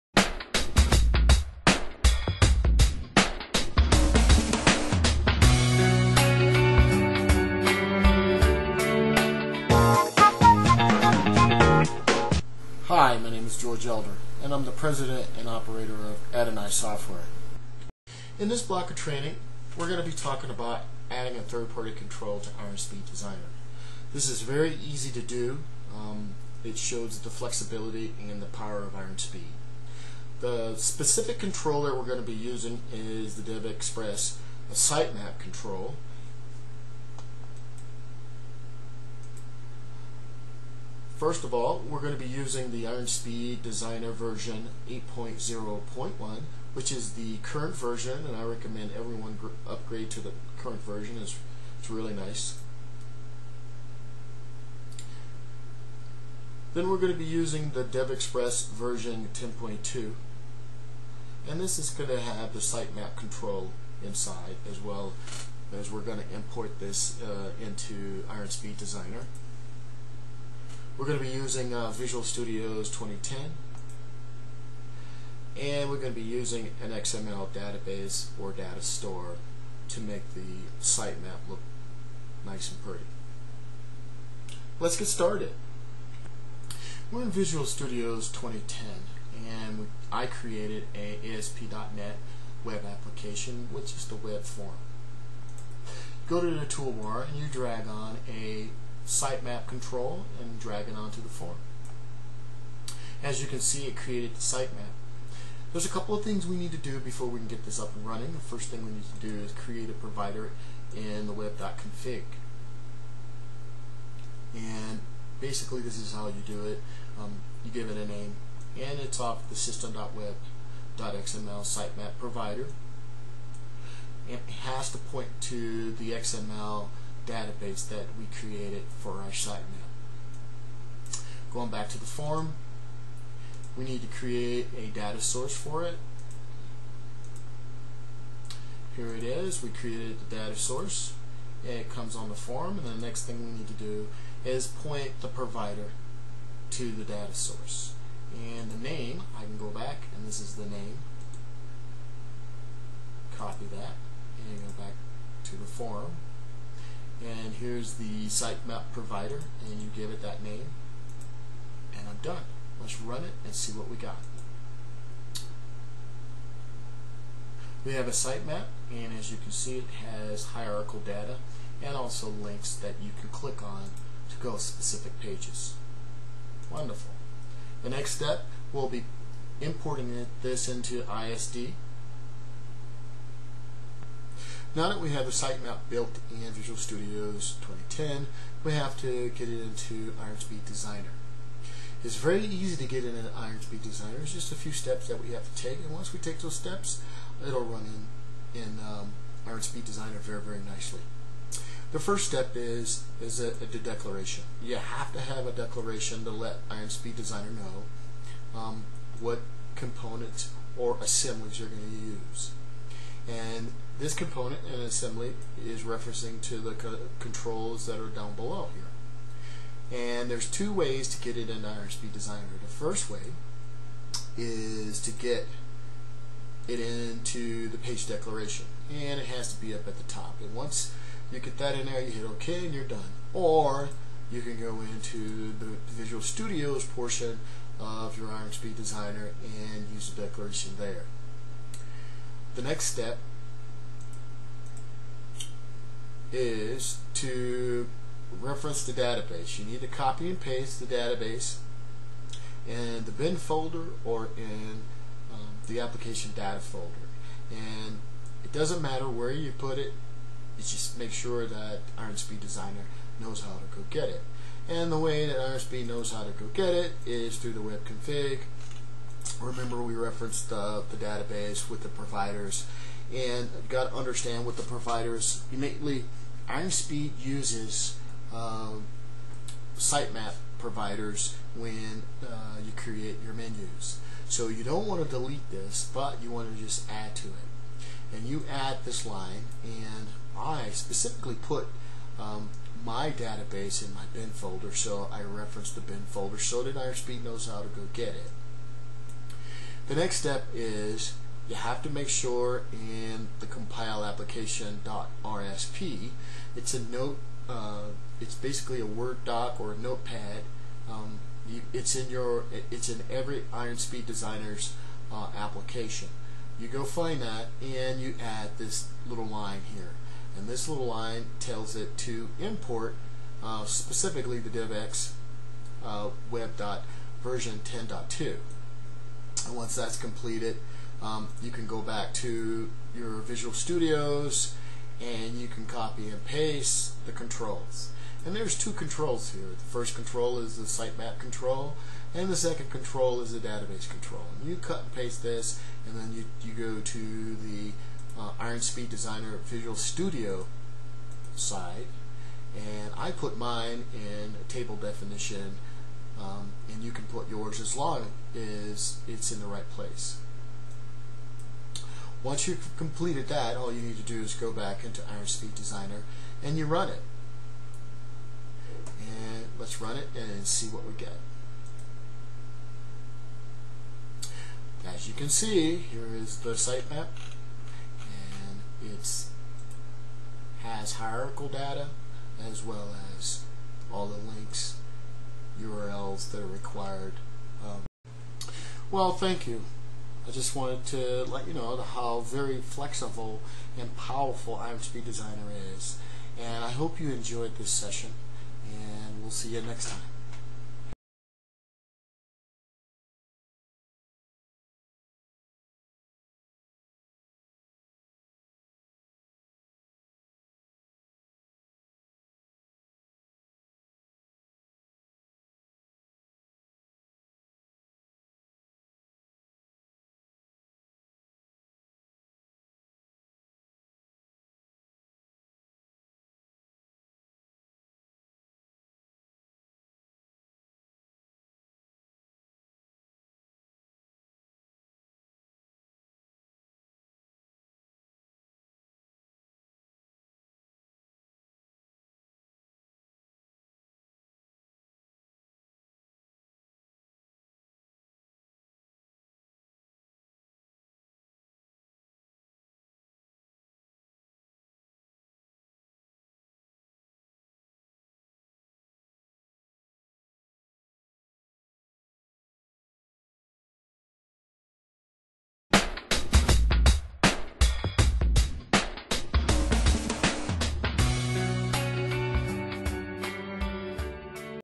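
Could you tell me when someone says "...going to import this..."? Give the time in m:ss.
1:06.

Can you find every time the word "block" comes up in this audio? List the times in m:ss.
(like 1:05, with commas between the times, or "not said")
0:18.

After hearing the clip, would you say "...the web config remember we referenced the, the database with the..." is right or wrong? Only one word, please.
right.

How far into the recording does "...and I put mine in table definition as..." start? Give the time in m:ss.
5:52.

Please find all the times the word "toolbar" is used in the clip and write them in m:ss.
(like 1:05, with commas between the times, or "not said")
1:36.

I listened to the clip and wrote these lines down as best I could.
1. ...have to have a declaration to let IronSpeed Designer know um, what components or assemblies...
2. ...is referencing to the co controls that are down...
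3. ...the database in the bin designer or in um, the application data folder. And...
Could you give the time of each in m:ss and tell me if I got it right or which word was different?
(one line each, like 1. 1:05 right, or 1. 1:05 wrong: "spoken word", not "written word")
1. 3:24 right
2. 3:35 right
3. 4:10 wrong: "folder", not "designer".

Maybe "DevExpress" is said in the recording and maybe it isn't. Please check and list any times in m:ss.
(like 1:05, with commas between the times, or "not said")
0:33, 0:57.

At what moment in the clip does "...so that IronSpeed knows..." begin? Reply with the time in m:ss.
4:56.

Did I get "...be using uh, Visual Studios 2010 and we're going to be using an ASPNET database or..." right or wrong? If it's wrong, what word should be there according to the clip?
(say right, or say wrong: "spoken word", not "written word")
wrong: "XML", not "ASPNET".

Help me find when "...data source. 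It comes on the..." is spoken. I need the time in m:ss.
2:20.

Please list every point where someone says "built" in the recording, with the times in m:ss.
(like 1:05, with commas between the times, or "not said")
3:05.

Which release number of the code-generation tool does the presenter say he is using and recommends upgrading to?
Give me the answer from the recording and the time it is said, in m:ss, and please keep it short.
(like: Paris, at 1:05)
8.0.1, at 0:44.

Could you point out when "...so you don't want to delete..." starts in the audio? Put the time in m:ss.
4:44.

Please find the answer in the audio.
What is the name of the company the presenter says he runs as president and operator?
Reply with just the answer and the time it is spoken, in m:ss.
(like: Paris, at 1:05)
Adonai Software, at 0:16.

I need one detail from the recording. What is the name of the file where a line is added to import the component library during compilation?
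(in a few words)
compile application.rsp.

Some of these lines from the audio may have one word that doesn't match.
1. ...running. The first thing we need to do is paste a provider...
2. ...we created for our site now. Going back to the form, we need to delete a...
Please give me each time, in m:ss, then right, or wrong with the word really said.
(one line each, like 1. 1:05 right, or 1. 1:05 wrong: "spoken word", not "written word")
1. 1:48 wrong: "create", not "paste"
2. 2:08 wrong: "create", not "delete".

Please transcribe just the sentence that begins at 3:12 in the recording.
It's very easy to get in an IronSpeed Designer.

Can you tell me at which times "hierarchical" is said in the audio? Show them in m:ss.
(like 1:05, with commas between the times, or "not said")
2:50, 6:20.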